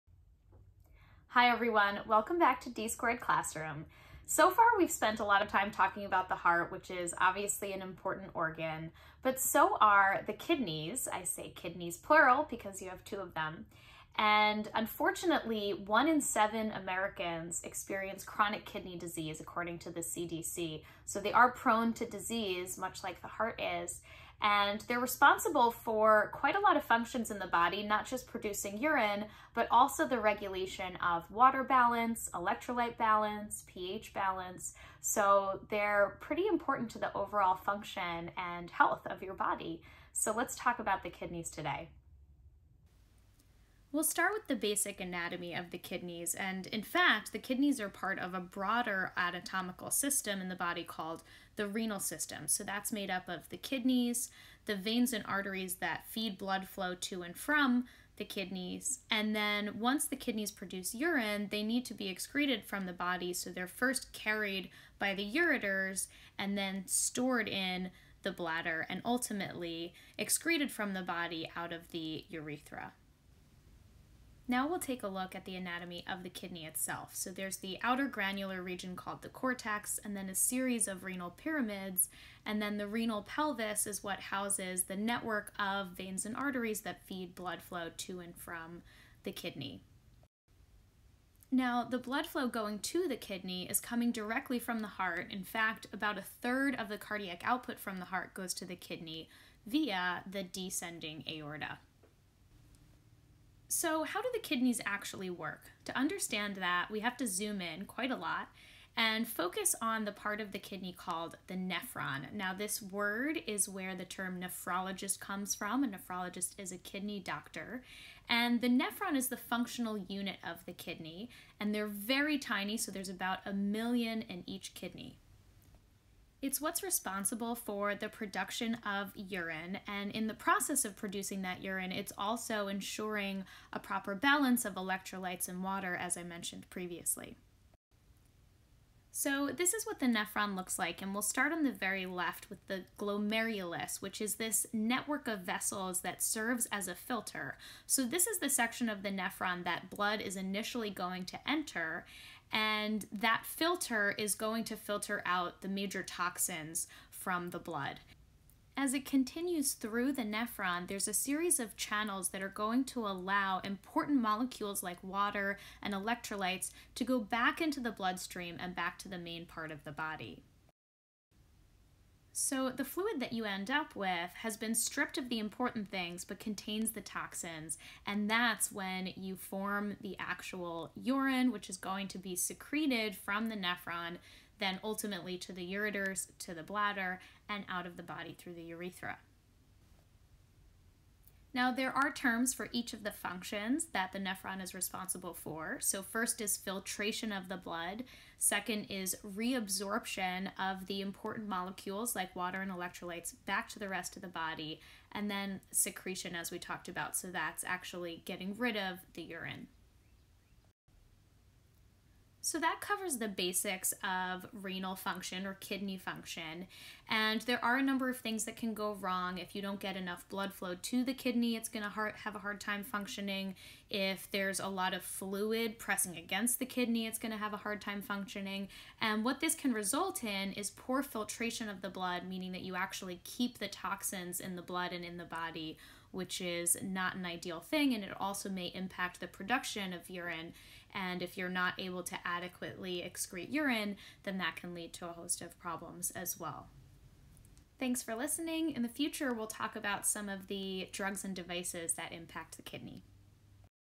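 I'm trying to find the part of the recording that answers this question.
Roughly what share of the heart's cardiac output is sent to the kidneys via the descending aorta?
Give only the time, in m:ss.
1:35.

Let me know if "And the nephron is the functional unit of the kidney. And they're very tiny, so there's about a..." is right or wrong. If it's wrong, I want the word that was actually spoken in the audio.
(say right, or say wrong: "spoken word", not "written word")
right.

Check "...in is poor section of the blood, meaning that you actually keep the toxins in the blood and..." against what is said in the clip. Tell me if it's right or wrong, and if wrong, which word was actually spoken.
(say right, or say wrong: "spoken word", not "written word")
wrong: "filtration", not "section".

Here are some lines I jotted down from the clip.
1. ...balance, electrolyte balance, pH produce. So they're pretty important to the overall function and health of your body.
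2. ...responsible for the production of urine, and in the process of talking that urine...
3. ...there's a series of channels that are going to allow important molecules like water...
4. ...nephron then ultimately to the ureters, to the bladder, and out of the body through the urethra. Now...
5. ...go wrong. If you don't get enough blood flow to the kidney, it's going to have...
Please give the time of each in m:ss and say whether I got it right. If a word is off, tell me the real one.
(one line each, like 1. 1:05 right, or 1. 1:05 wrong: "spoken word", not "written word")
1. 0:31 wrong: "balance", not "produce"
2. 2:06 wrong: "producing", not "talking"
3. 2:40 right
4. 3:03 right
5. 3:38 right.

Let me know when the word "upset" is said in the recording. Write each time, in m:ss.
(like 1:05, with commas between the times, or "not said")
not said.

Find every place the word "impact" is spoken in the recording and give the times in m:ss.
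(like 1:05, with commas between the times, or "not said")
3:58, 4:12.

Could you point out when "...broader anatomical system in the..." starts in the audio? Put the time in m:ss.
0:48.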